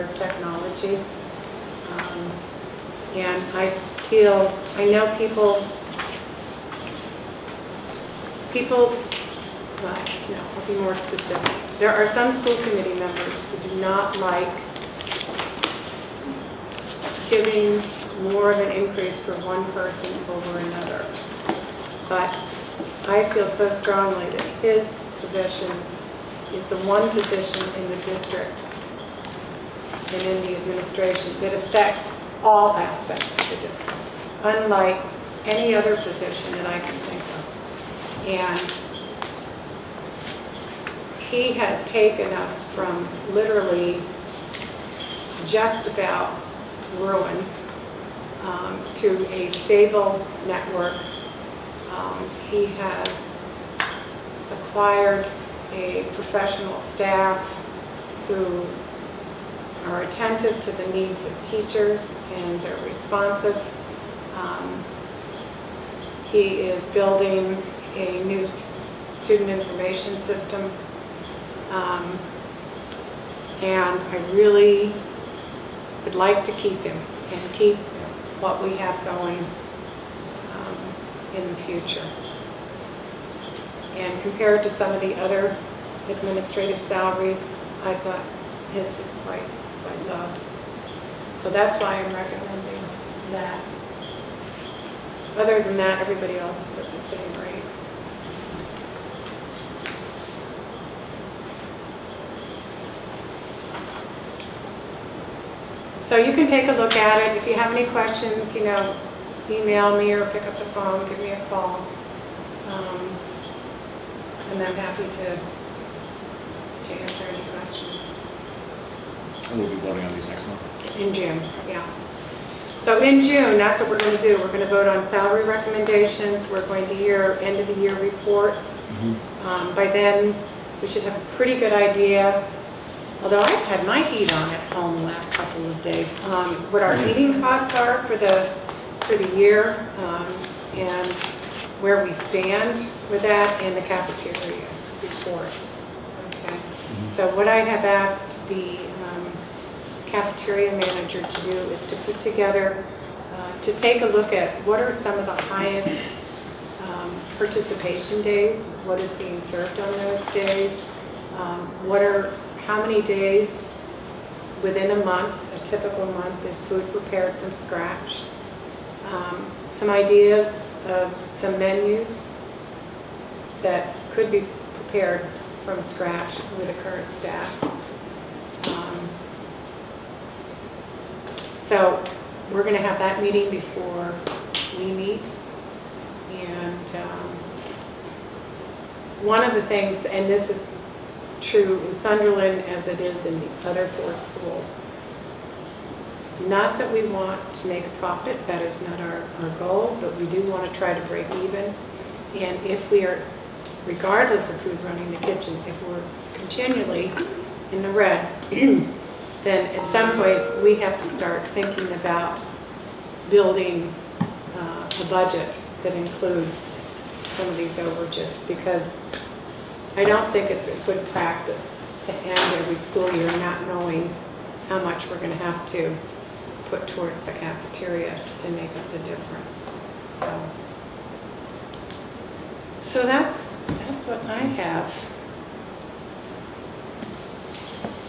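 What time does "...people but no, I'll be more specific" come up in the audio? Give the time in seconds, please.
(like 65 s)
8 s.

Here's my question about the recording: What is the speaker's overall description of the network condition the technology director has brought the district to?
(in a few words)
a stable network.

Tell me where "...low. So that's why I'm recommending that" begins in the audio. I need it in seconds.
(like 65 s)
90 s.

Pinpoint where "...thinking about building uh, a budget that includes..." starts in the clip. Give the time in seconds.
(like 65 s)
211 s.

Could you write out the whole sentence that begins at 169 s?
Um, some ideas of some menus that could be prepared from scratch with the current staff.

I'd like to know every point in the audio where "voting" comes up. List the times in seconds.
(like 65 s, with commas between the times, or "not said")
119 s.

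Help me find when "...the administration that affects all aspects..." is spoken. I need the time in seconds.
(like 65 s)
30 s.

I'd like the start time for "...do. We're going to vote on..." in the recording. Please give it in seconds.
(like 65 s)
124 s.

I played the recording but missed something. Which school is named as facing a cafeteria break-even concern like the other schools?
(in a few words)
Sunderland.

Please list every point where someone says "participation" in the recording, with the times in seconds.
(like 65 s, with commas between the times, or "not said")
157 s.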